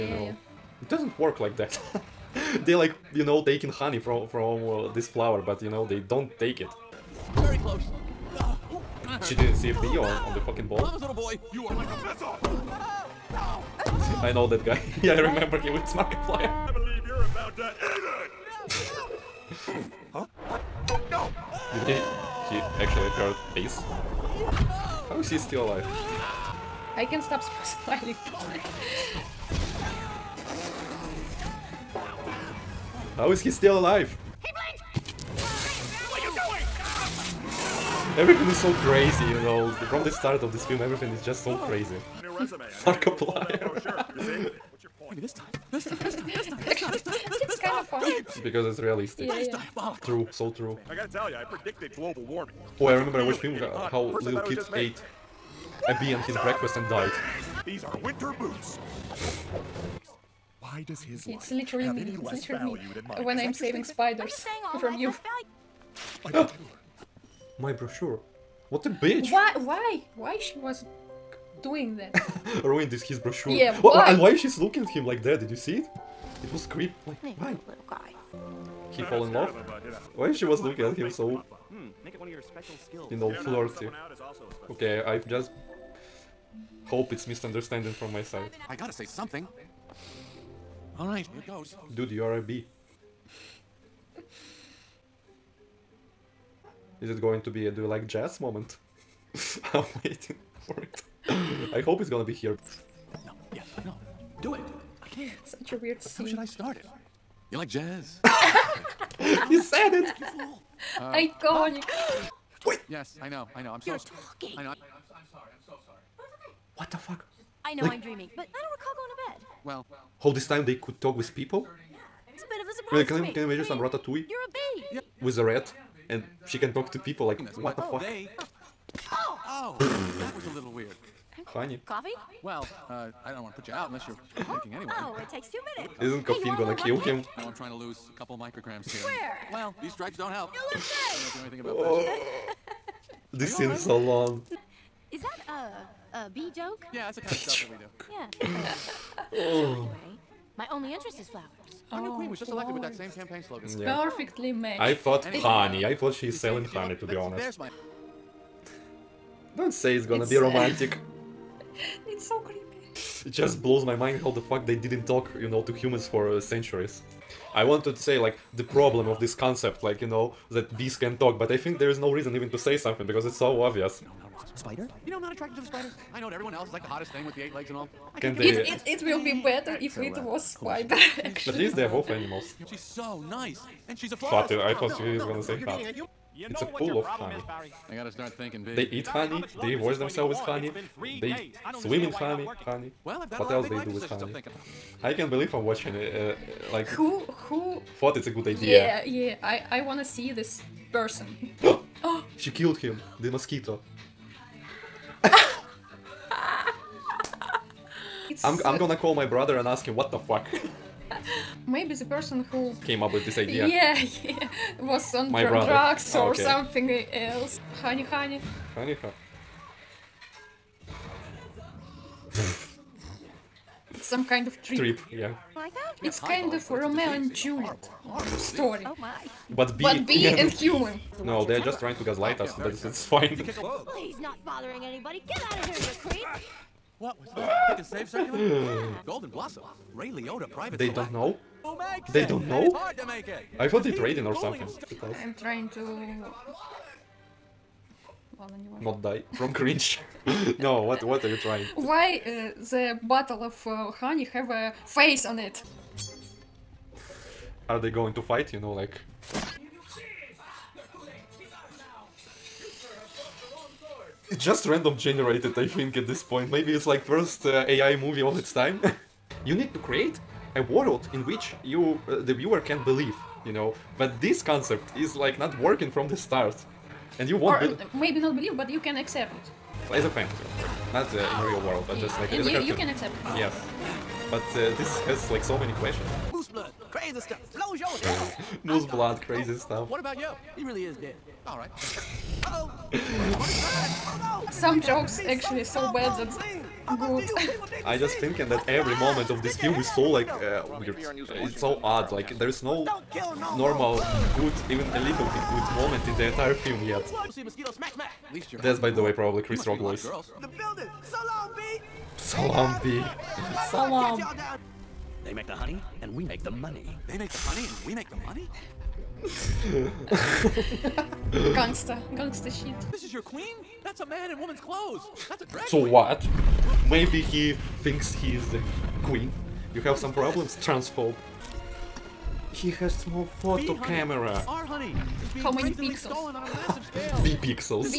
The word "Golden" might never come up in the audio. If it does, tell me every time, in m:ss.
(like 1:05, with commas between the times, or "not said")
3:59.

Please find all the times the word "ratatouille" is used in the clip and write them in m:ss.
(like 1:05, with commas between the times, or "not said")
2:03.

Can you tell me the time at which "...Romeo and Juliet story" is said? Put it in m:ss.
3:46.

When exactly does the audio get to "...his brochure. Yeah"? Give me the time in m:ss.
1:13.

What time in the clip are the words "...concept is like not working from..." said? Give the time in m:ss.
4:34.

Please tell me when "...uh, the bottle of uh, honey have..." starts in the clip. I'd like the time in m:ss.
4:12.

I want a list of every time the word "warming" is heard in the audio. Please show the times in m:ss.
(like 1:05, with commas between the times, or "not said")
0:52.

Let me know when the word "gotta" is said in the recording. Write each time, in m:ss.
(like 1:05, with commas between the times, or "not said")
0:50, 1:28, 3:07.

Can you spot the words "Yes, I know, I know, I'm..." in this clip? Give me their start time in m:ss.
1:52.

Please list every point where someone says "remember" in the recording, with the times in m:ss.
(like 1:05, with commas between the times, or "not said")
0:15, 0:52.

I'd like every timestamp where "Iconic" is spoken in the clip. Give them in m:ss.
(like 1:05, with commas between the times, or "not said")
1:50.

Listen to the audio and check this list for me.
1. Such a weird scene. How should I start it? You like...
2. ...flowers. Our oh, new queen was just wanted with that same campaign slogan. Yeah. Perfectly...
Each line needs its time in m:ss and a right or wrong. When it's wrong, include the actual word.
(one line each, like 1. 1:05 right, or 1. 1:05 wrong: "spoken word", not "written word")
1. 1:45 right
2. 2:31 wrong: "elected", not "wanted".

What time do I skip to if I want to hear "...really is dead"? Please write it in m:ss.
4:50.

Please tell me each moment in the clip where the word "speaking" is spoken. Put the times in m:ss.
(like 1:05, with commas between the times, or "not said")
not said.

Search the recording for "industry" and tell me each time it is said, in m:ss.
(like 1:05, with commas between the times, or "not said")
not said.